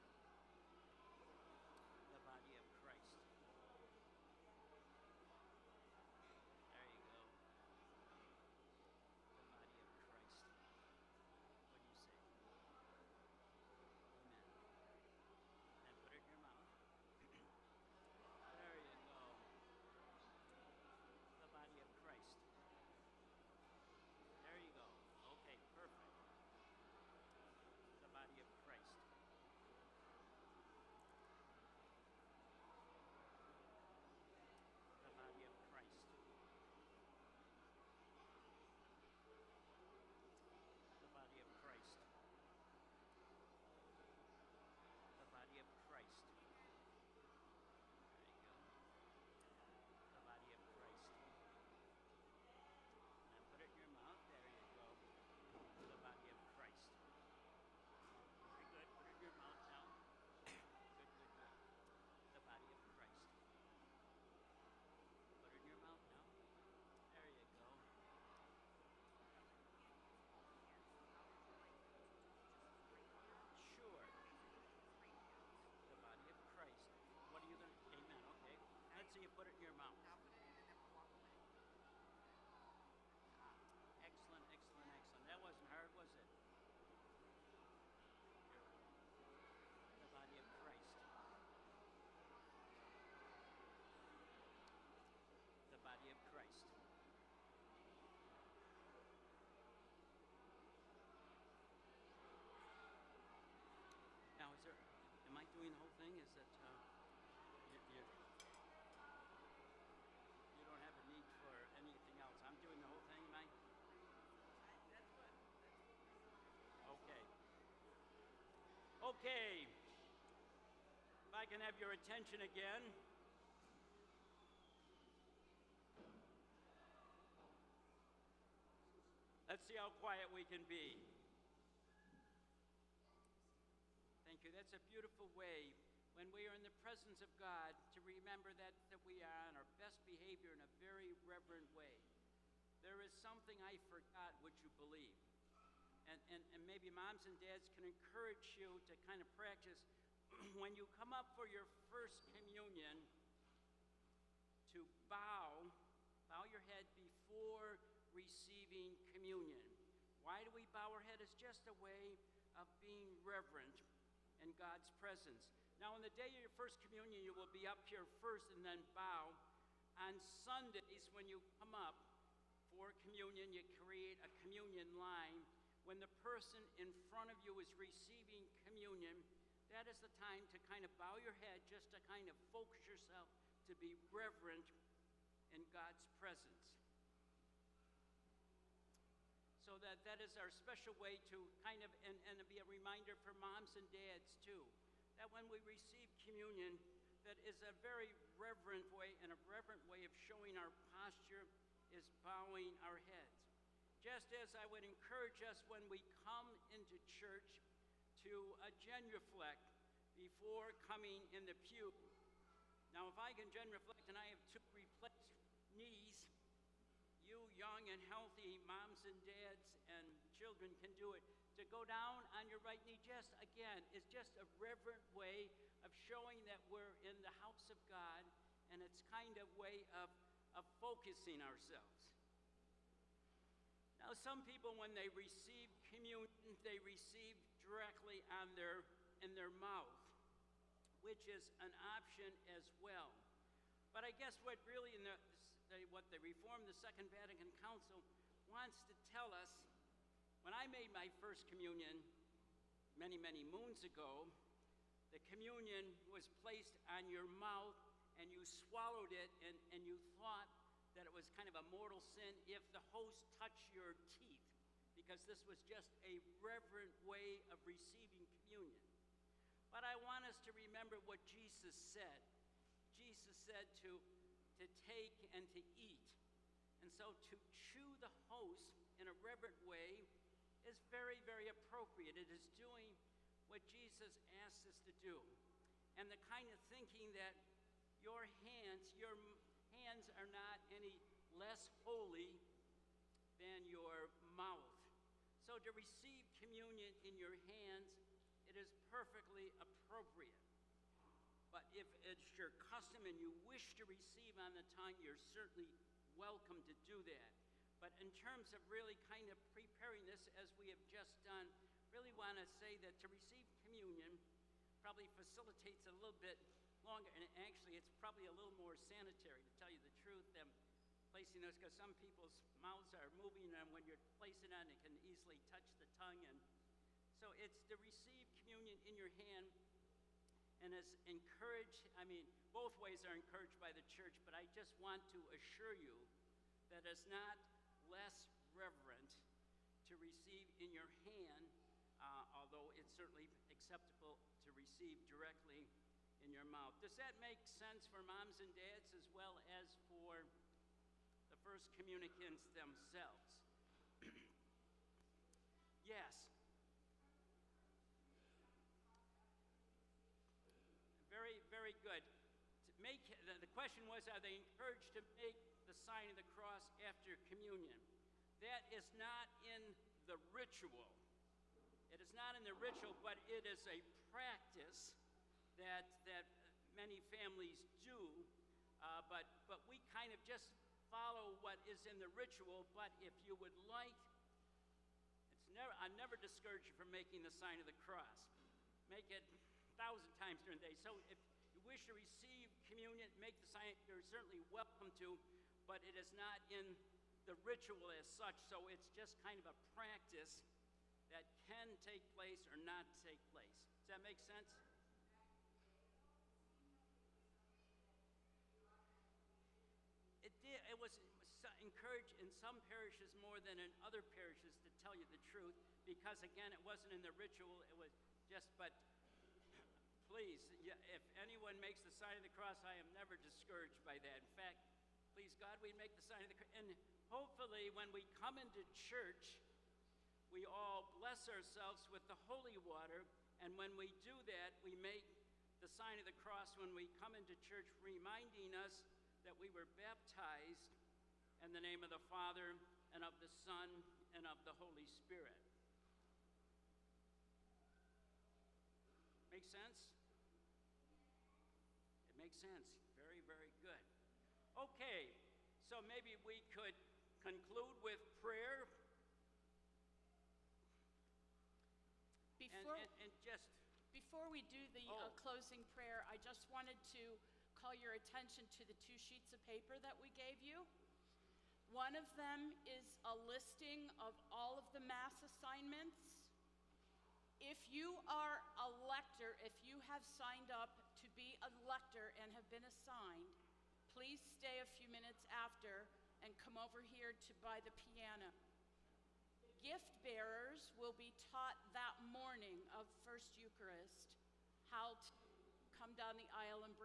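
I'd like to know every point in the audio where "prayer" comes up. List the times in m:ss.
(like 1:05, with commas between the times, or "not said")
7:38, 7:45.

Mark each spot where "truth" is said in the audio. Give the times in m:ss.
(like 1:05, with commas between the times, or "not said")
5:20, 6:55.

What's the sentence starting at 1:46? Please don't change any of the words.
Is that uh, you, you, you, don't have a need for anything else?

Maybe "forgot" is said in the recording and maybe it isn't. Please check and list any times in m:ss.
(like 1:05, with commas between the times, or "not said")
2:23.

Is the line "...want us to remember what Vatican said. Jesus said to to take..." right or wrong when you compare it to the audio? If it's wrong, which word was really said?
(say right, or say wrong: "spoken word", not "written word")
wrong: "Jesus", not "Vatican".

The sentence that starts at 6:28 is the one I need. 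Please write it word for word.
Make it thousand times during the day.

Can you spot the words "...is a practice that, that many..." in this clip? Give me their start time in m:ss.
6:13.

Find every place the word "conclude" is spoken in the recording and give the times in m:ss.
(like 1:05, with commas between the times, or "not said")
7:37.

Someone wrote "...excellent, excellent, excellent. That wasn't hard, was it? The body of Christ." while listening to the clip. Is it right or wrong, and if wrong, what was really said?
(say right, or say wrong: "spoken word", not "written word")
right.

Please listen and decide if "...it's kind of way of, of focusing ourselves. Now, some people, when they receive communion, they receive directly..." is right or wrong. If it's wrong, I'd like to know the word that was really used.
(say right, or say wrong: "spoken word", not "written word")
right.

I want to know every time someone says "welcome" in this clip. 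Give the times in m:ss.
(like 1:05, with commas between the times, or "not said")
5:06, 6:34.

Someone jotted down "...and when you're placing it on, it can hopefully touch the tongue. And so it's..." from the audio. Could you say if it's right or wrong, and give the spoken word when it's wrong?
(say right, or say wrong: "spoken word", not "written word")
wrong: "easily", not "hopefully".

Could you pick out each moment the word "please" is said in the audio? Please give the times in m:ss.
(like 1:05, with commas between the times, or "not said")
7:00, 7:05, 8:03.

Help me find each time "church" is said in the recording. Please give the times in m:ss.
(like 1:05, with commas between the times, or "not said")
3:27, 5:33, 7:08, 7:17.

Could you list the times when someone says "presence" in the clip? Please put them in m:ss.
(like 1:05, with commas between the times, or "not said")
2:16, 2:44, 3:06.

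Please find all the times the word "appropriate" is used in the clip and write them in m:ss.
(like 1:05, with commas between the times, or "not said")
4:41, 4:59.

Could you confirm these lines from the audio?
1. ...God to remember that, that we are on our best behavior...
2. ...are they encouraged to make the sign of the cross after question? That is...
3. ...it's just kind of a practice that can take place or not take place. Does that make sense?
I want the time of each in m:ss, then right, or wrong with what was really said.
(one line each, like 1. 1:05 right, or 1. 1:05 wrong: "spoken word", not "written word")
1. 2:17 right
2. 6:04 wrong: "communion", not "question"
3. 6:38 right.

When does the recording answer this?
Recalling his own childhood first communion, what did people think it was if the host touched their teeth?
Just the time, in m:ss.
4:21.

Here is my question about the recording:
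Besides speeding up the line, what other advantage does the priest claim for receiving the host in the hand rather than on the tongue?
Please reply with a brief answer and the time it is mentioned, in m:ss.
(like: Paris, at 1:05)
more sanitary, at 5:18.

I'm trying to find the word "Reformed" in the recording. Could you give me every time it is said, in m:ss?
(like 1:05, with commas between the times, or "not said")
4:06.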